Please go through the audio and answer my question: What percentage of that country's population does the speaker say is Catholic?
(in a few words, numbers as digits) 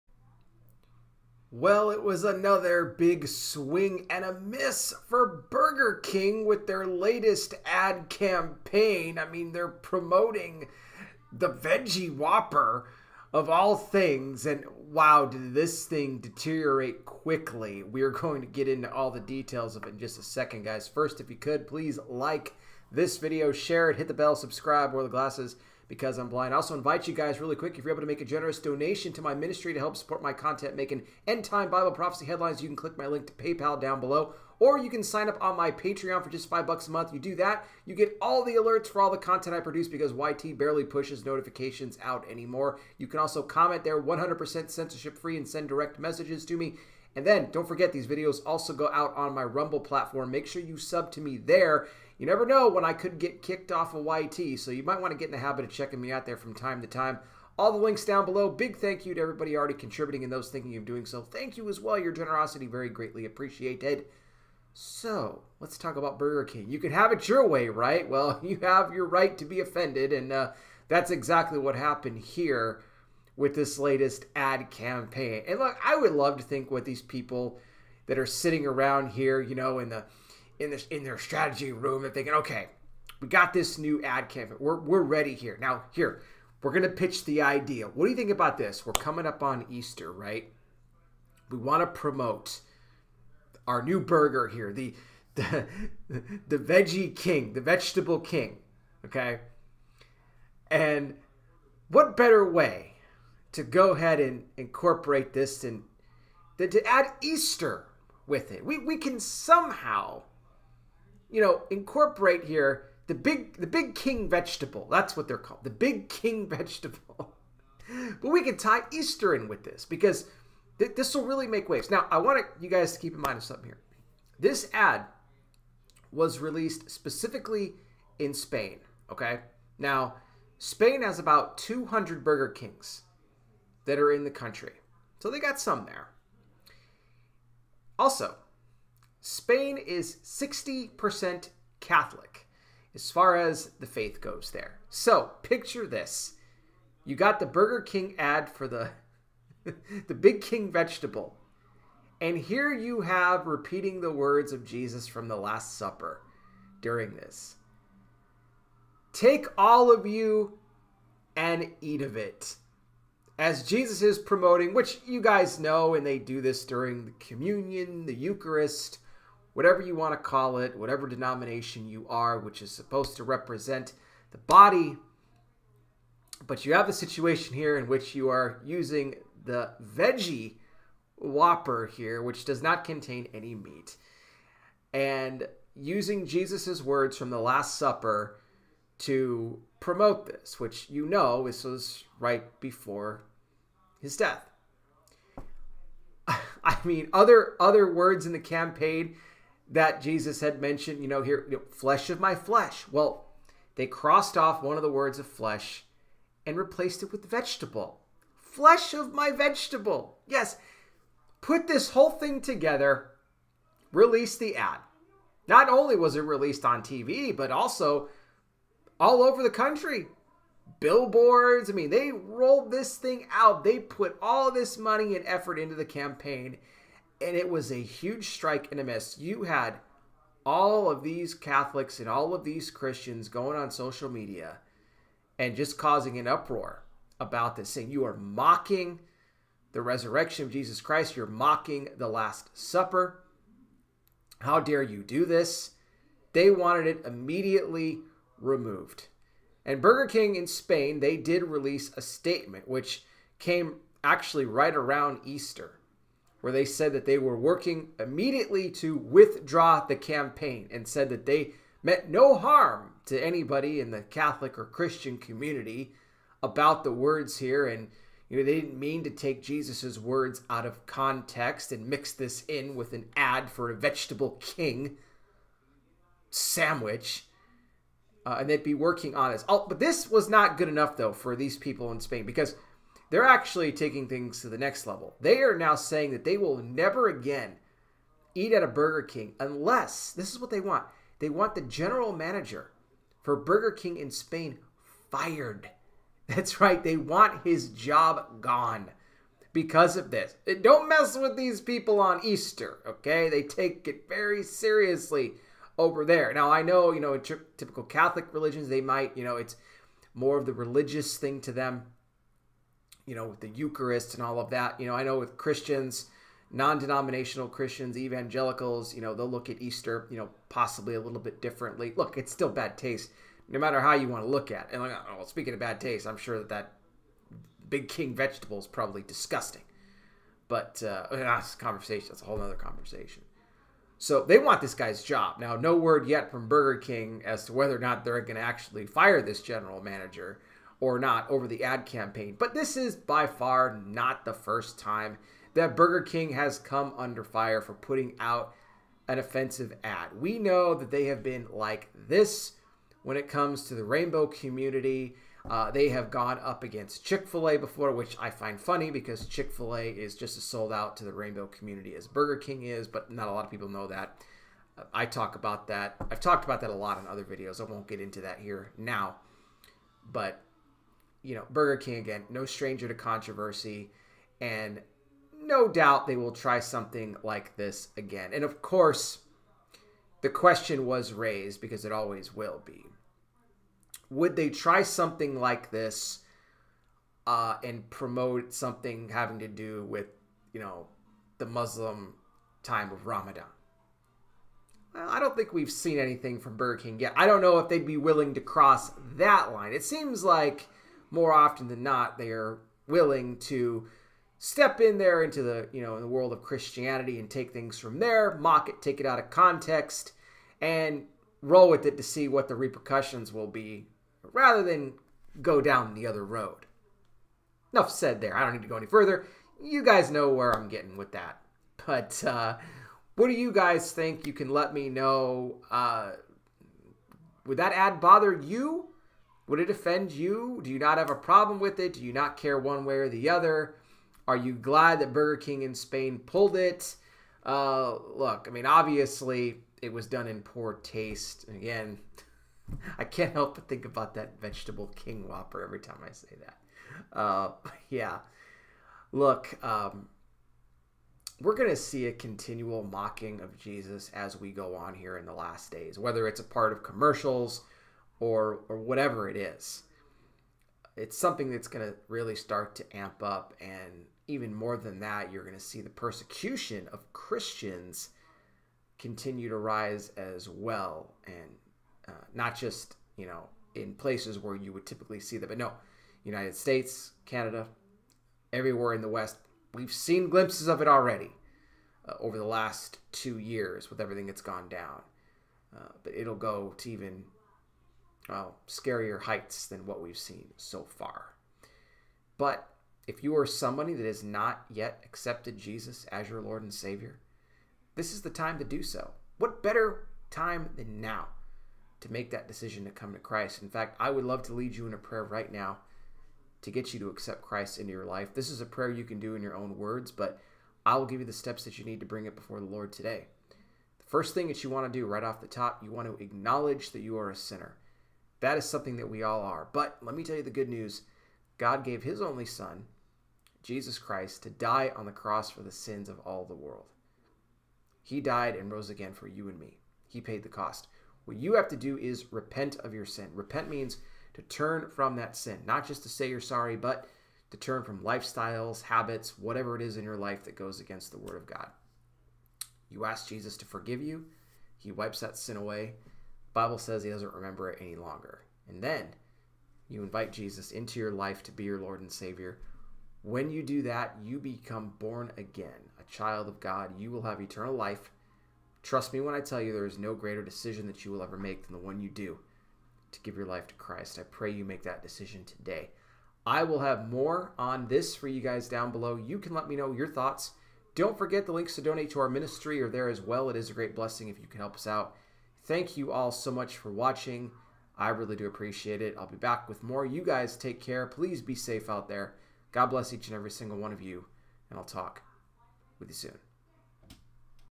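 60%.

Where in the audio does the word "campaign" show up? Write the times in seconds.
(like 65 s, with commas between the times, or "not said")
8 s, 74 s, 84 s, 198 s, 225 s, 259 s, 341 s.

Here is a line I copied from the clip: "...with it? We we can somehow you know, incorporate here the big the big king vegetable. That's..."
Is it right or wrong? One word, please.
right.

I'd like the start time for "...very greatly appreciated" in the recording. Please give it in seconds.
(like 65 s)
62 s.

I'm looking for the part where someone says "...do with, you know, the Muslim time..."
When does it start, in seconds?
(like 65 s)
389 s.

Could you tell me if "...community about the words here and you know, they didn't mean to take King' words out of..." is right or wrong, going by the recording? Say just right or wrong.
wrong.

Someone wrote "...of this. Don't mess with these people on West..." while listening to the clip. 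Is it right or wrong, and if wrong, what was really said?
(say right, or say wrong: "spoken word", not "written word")
wrong: "Easter", not "West".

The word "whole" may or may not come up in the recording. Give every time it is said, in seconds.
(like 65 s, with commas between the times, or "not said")
211 s, 332 s.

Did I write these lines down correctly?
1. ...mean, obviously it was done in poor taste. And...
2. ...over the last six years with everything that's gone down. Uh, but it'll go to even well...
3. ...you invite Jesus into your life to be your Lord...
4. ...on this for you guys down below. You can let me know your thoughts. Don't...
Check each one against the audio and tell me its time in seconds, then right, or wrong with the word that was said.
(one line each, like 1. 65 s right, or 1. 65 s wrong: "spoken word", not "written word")
1. 438 s right
2. 482 s wrong: "two", not "six"
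3. 549 s right
4. 567 s right.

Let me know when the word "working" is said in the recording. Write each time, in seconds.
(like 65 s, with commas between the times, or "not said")
257 s, 278 s.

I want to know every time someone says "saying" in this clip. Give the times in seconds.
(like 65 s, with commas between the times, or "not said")
237 s, 285 s.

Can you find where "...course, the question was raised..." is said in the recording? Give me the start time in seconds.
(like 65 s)
378 s.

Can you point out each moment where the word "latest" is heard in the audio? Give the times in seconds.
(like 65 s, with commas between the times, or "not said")
6 s, 73 s.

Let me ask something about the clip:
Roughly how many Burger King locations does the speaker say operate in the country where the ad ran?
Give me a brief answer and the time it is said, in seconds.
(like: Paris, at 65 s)
200, at 131 s.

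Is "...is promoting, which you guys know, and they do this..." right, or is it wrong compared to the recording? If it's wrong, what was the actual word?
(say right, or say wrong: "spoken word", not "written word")
right.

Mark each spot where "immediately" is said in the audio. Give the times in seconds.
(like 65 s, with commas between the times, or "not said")
247 s, 257 s.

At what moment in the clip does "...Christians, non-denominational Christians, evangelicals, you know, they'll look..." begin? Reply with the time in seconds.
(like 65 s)
315 s.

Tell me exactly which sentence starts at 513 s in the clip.
The first thing that you want to do right off the top, you want to acknowledge that you are a sinner.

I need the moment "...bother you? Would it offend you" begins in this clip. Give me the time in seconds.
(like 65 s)
428 s.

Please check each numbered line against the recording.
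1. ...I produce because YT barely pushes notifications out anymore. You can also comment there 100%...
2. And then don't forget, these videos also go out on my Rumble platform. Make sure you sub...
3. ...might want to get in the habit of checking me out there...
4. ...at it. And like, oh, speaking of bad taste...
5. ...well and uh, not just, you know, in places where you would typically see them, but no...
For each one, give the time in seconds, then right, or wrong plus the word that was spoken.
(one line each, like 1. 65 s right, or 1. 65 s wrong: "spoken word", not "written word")
1. 39 s right
2. 47 s right
3. 54 s right
4. 324 s right
5. 470 s right.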